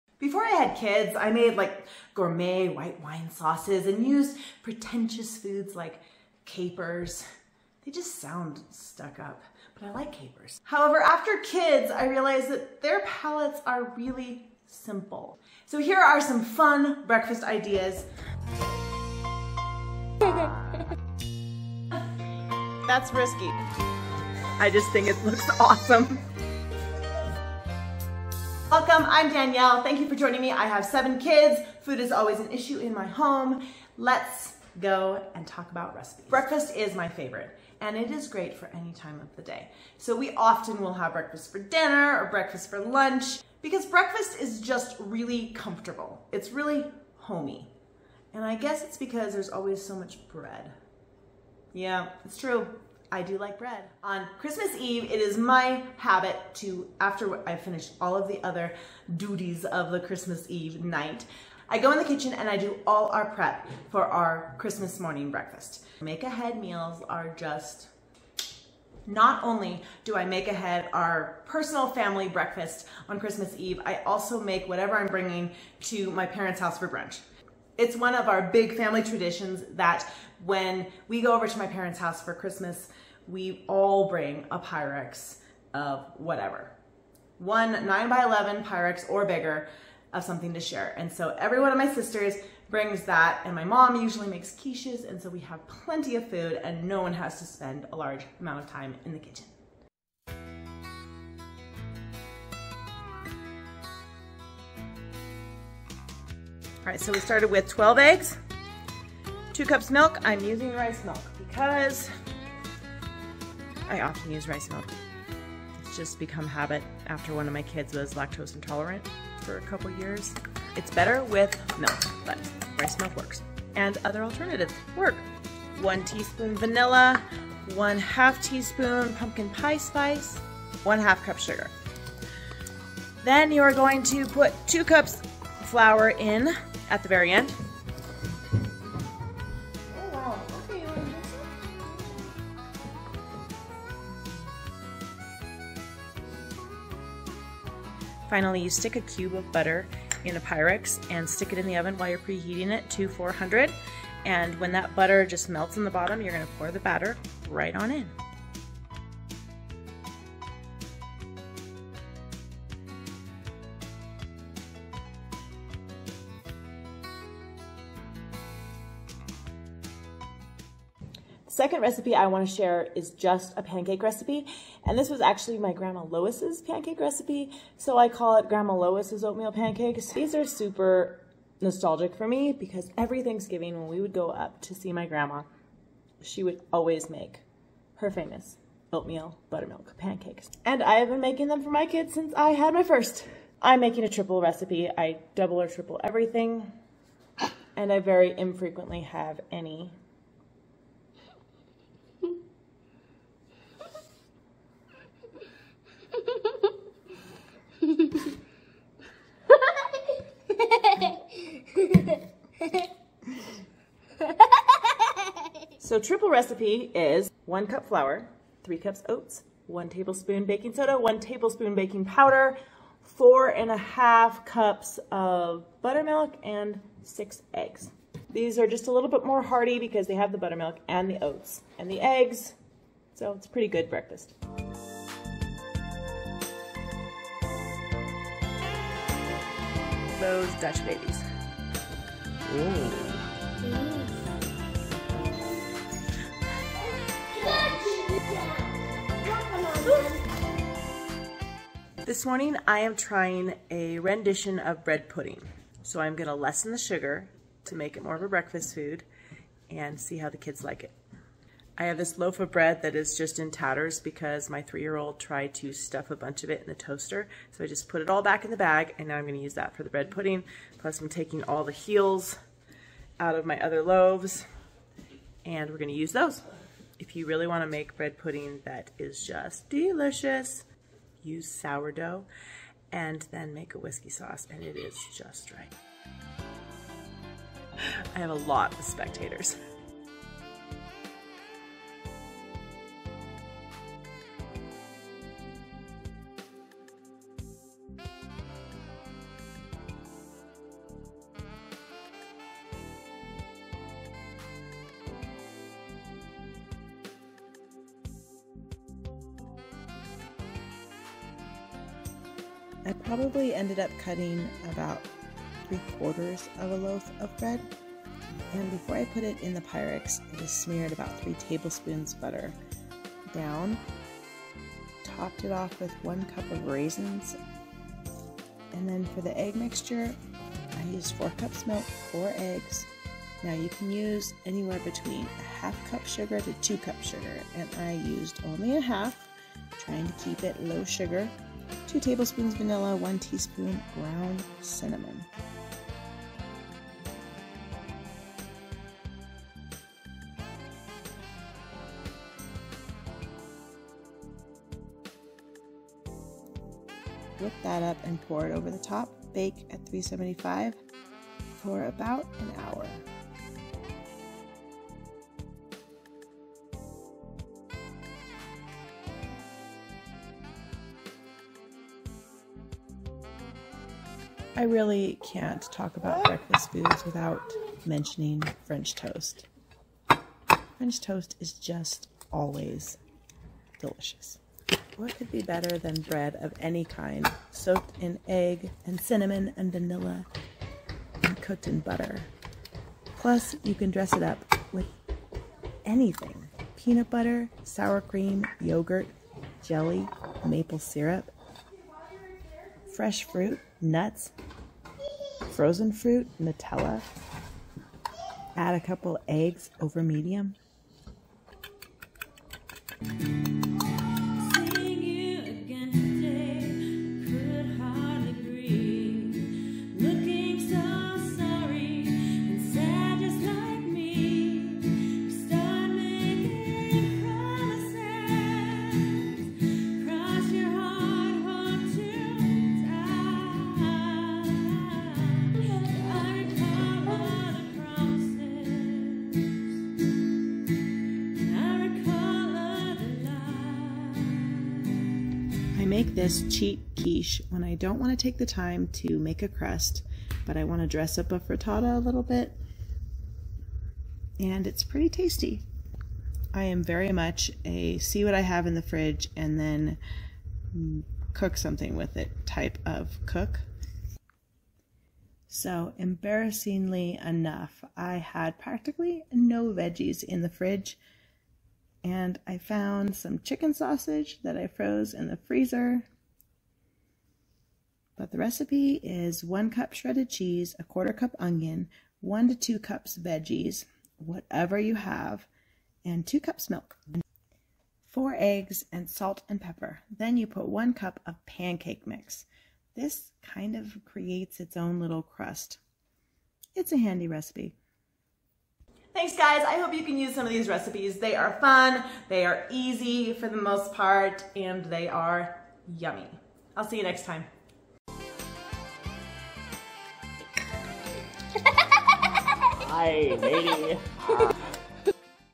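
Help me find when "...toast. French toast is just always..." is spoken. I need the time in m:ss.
6:18.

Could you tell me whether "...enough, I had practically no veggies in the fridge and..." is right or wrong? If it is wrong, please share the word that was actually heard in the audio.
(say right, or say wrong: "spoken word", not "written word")
right.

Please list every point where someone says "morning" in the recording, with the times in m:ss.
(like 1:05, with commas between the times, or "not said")
1:04, 4:12.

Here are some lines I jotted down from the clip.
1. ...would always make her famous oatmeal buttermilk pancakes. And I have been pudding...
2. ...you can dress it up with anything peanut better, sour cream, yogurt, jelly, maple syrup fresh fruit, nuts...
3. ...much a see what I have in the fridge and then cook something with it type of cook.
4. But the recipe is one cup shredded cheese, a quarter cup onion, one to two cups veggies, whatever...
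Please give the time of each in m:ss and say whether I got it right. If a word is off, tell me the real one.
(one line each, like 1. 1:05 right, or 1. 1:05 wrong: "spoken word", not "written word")
1. 3:06 wrong: "making", not "pudding"
2. 6:33 wrong: "butter", not "better"
3. 7:37 right
4. 7:58 right.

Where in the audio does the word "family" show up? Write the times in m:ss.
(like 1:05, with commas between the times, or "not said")
1:11, 1:18.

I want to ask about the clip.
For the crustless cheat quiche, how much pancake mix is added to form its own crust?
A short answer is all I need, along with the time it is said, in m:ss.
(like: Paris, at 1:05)
1 cup, at 8:10.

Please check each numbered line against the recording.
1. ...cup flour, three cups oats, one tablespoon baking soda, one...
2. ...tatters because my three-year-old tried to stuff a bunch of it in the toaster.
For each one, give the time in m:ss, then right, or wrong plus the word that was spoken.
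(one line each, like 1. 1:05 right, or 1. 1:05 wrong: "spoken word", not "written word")
1. 3:37 right
2. 4:23 right.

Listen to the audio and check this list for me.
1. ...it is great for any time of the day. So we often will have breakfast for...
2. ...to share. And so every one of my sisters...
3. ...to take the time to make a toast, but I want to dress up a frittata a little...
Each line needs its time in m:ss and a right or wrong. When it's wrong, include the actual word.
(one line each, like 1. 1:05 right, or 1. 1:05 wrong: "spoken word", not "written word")
1. 0:37 right
2. 1:30 right
3. 7:28 wrong: "crust", not "toast".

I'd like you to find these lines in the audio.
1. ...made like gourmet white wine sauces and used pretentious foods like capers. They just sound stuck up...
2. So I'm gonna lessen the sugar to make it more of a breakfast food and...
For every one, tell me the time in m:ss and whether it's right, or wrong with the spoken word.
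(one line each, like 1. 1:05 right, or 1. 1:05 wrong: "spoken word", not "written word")
1. 0:01 right
2. 4:15 right.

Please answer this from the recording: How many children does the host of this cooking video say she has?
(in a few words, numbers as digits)
7.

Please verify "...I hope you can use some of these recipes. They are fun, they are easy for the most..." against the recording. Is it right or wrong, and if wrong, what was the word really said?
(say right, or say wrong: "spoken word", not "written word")
right.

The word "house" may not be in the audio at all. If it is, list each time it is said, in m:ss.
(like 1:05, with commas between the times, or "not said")
1:16, 1:21.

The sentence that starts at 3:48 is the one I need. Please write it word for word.
These are just a little bit more hearty because they have the buttermilk and the oats and the eggs.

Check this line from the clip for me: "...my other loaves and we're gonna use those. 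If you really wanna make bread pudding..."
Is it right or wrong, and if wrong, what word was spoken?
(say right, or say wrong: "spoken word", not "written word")
right.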